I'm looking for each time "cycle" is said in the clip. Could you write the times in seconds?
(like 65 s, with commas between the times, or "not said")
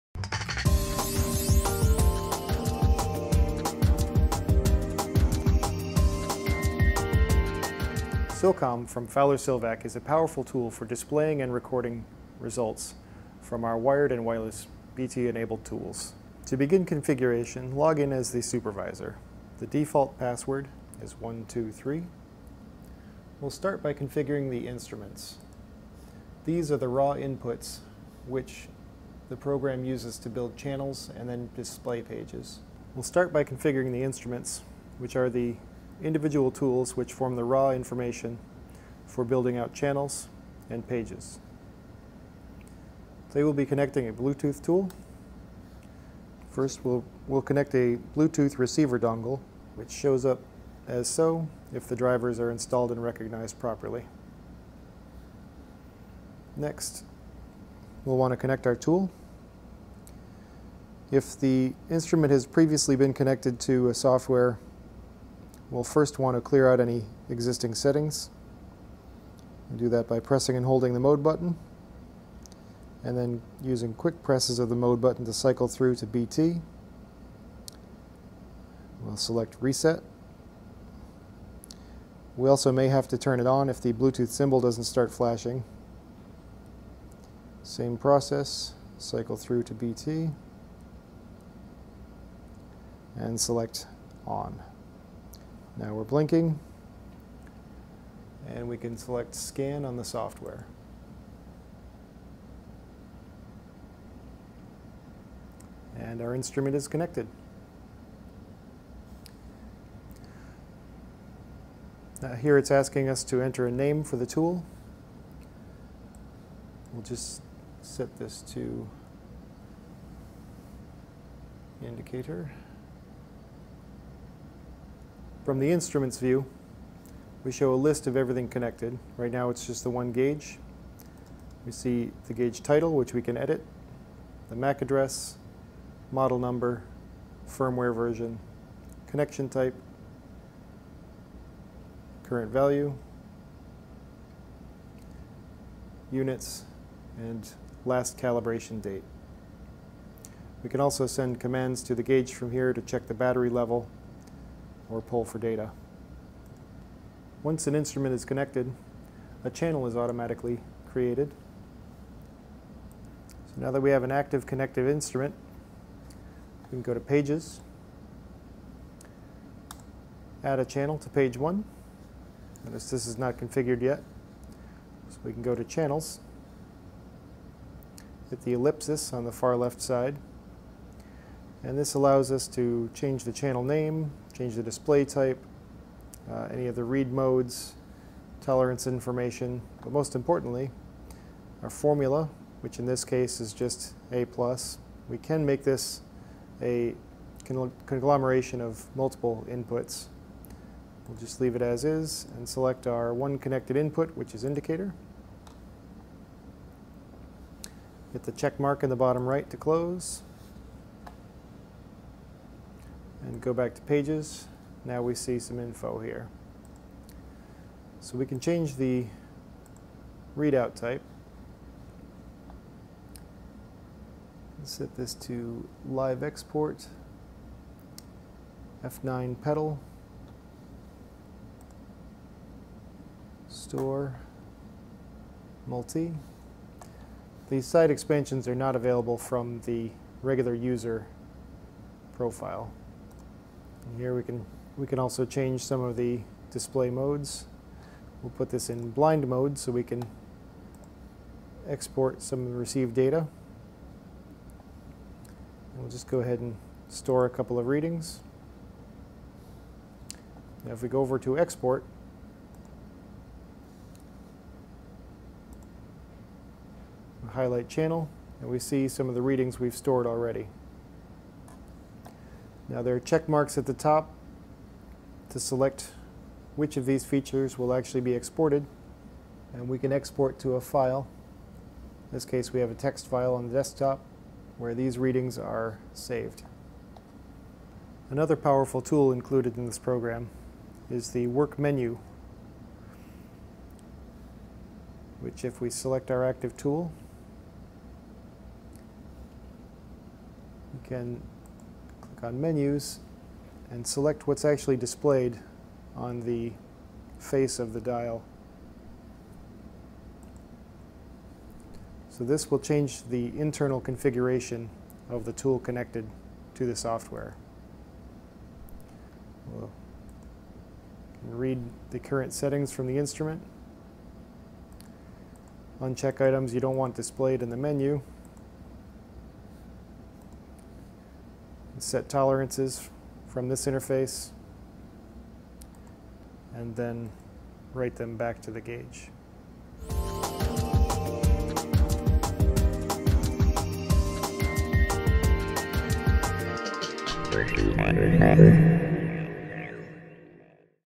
75 s, 88 s.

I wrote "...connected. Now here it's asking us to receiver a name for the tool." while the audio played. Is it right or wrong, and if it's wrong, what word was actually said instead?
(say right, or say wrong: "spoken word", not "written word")
wrong: "enter", not "receiver".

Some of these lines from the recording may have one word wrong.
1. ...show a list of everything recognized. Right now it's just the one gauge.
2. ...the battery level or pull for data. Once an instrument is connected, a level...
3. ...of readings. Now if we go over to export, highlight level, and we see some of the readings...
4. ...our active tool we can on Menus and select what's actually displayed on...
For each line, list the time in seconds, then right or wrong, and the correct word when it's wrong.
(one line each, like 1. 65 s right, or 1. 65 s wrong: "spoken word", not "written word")
1. 127 s wrong: "connected", not "recognized"
2. 153 s wrong: "channel", not "level"
3. 257 s wrong: "channel", not "level"
4. 296 s right.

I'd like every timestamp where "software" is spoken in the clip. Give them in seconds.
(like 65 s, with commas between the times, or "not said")
63 s, 100 s, 316 s.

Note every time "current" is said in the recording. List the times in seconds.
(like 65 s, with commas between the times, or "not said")
142 s, 321 s.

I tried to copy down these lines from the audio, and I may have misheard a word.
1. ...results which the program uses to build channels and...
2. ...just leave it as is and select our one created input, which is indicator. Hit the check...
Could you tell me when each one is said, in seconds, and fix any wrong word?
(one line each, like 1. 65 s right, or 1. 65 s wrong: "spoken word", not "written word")
1. 27 s wrong: "inputs", not "results"
2. 201 s wrong: "connected", not "created".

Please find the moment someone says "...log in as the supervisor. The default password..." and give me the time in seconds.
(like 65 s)
17 s.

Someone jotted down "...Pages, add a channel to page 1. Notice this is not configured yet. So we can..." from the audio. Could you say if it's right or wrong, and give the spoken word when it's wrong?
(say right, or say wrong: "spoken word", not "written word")
right.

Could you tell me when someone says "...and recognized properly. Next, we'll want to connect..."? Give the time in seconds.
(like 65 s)
52 s.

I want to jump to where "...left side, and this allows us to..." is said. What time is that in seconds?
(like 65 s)
179 s.